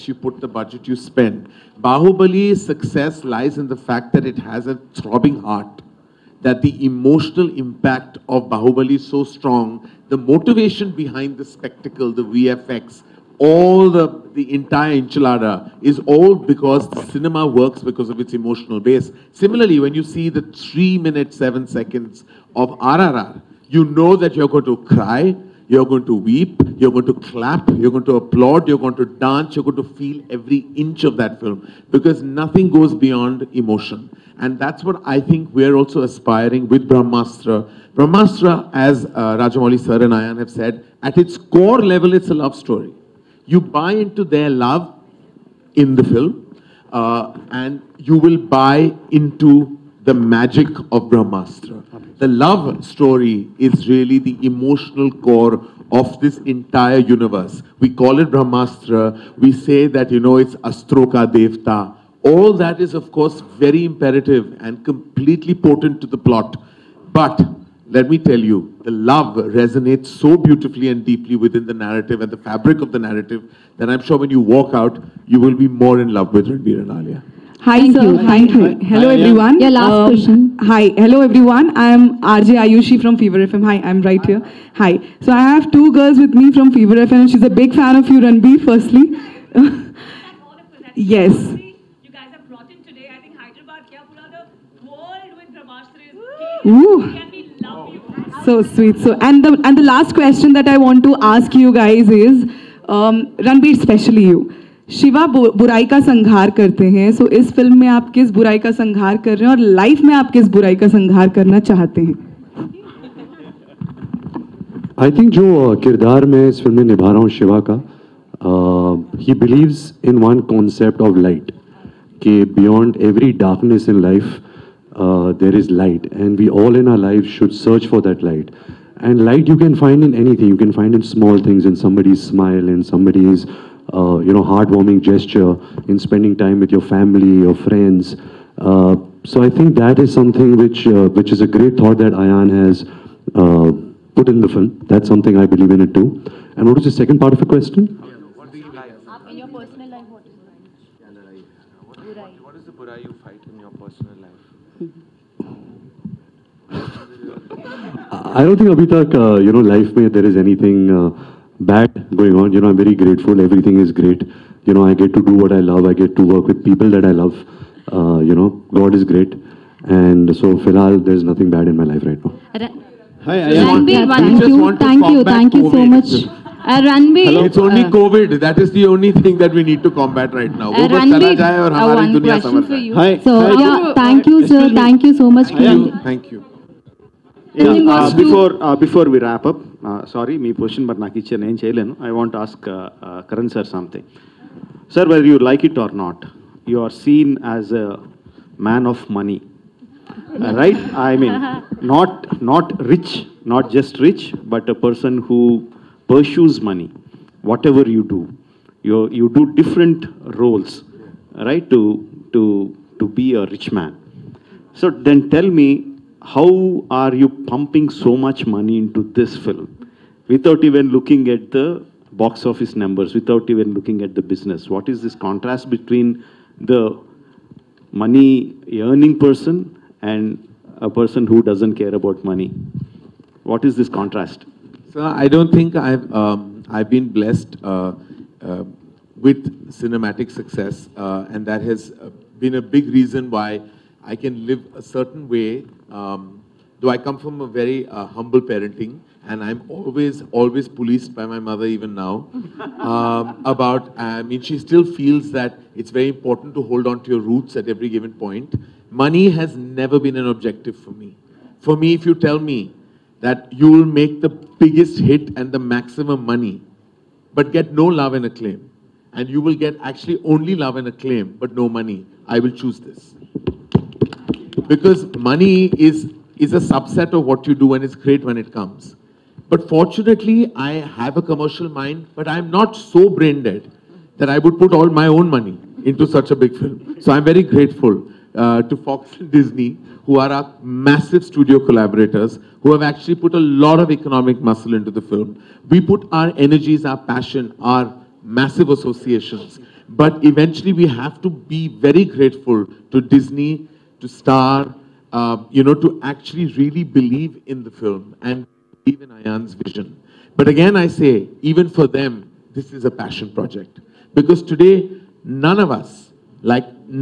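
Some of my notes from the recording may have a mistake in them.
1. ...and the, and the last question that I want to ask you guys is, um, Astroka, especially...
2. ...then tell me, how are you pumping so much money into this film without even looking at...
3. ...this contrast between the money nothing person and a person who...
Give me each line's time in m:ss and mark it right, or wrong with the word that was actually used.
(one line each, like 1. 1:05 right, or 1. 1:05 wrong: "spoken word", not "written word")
1. 1:39 wrong: "Ranbir", not "Astroka"
2. 3:34 right
3. 3:45 wrong: "earning", not "nothing".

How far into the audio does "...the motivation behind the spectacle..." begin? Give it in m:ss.
0:10.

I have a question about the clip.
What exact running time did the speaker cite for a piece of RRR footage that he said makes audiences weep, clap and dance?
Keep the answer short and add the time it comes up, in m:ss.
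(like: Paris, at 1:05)
3 minutes 7 seconds, at 0:20.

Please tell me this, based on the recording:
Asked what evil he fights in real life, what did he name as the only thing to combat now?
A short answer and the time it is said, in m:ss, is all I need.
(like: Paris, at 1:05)
COVID, at 2:57.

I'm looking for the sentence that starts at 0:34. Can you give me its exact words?
And that's what I think we're also aspiring with Brahmastra.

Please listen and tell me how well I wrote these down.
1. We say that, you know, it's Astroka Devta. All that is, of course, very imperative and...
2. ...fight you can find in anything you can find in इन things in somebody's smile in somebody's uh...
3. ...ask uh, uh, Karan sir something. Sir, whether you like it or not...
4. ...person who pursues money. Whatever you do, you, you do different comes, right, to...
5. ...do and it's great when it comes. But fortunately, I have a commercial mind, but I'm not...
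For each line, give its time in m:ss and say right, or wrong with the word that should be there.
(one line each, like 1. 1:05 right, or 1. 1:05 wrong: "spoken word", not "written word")
1. 0:59 right
2. 2:09 wrong: "light", not "fight"
3. 3:12 right
4. 3:24 wrong: "roles", not "comes"
5. 4:37 right.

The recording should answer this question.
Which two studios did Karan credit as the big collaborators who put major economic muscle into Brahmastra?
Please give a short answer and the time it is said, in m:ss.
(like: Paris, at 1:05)
Fox and Disney, at 4:48.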